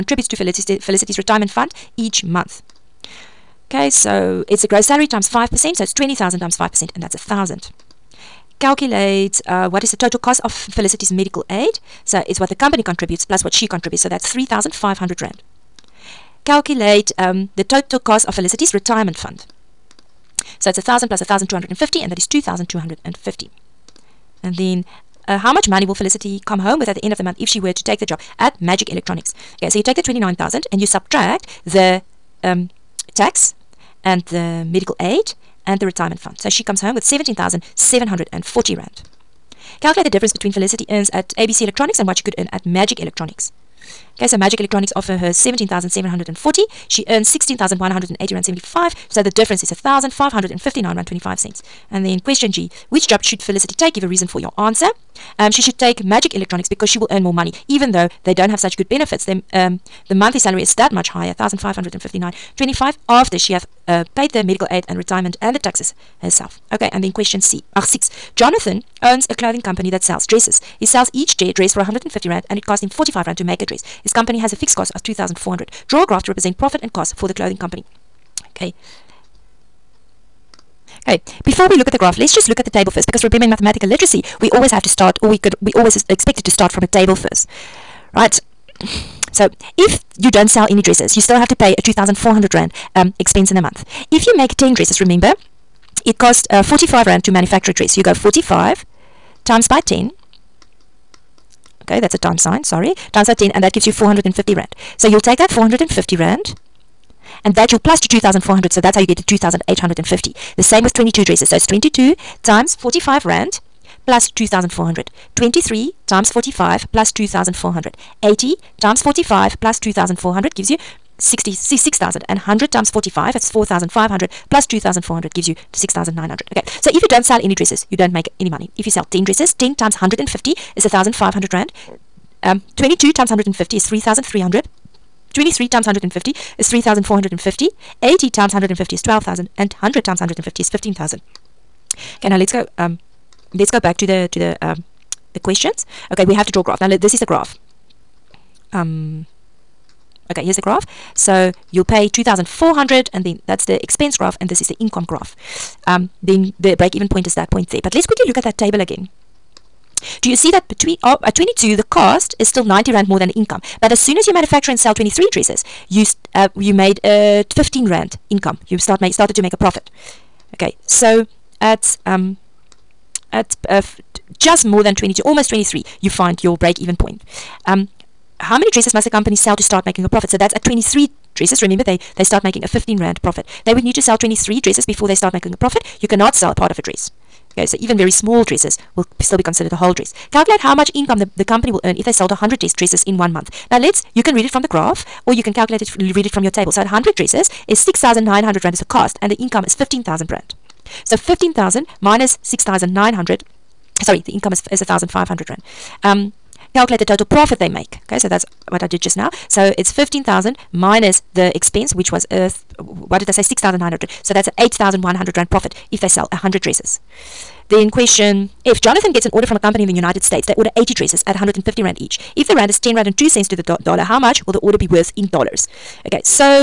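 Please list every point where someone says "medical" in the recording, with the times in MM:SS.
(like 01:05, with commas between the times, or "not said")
00:11, 00:34, 01:04.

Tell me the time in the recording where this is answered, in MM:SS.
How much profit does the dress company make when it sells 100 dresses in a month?
03:34.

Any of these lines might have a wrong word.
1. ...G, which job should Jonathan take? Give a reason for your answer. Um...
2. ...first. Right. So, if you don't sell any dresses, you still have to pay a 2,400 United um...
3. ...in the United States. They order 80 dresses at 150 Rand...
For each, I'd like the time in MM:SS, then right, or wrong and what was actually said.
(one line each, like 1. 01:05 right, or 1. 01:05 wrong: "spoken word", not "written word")
1. 00:52 wrong: "Felicity", not "Jonathan"
2. 01:27 wrong: "Rand", not "United"
3. 03:39 right.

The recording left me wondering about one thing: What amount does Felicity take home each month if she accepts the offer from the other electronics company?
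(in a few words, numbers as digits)
R17,740.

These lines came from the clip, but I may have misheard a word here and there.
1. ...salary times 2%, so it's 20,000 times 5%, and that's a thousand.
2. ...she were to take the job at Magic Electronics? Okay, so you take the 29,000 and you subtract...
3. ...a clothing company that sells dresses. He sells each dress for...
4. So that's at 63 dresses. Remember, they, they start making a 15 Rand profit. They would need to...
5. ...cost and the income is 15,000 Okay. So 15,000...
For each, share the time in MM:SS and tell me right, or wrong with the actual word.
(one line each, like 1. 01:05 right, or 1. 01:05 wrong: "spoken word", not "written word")
1. 00:04 wrong: "5", not "2"
2. 00:27 right
3. 01:09 right
4. 03:00 wrong: "23", not "63"
5. 03:18 wrong: "Rand", not "Okay".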